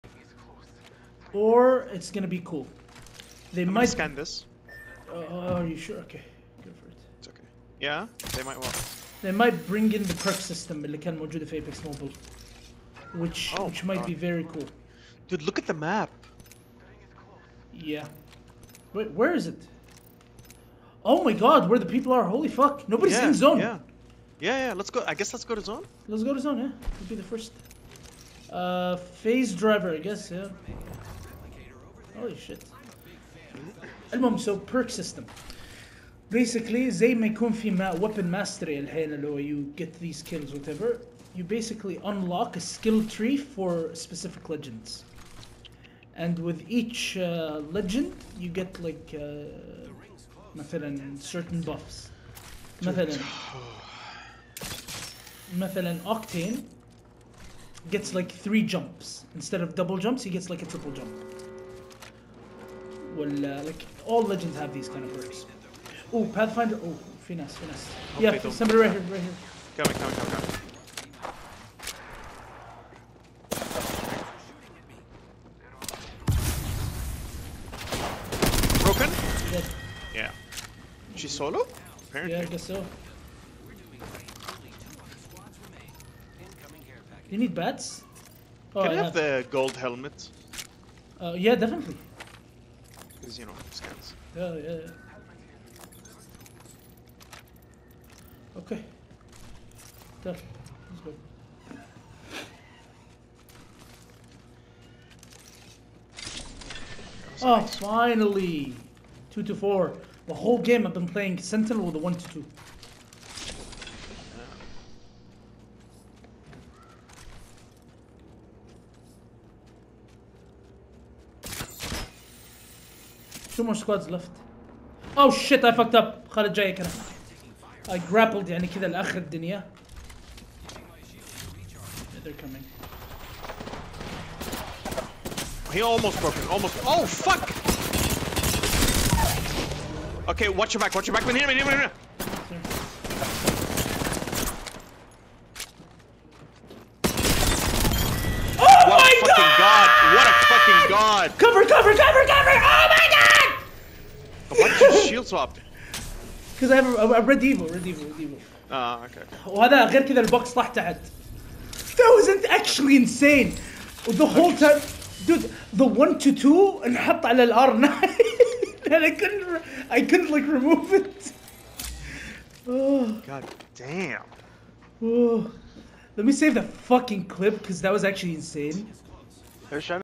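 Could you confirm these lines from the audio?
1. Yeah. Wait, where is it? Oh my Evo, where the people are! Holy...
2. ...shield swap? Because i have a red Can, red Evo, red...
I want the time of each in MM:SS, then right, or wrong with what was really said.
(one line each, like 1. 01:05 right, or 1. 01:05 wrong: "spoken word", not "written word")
1. 00:17 wrong: "God", not "Evo"
2. 02:35 wrong: "Evo", not "Can".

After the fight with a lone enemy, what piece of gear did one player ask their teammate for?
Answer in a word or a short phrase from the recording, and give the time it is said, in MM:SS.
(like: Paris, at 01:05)
gold helmet, at 01:29.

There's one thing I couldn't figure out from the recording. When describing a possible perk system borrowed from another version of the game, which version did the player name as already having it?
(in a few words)
Apex Mobile.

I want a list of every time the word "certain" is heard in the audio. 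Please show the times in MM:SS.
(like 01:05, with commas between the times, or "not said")
00:51.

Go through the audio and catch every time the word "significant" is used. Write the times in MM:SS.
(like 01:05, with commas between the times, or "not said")
not said.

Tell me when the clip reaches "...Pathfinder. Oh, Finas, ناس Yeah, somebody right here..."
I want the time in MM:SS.
01:06.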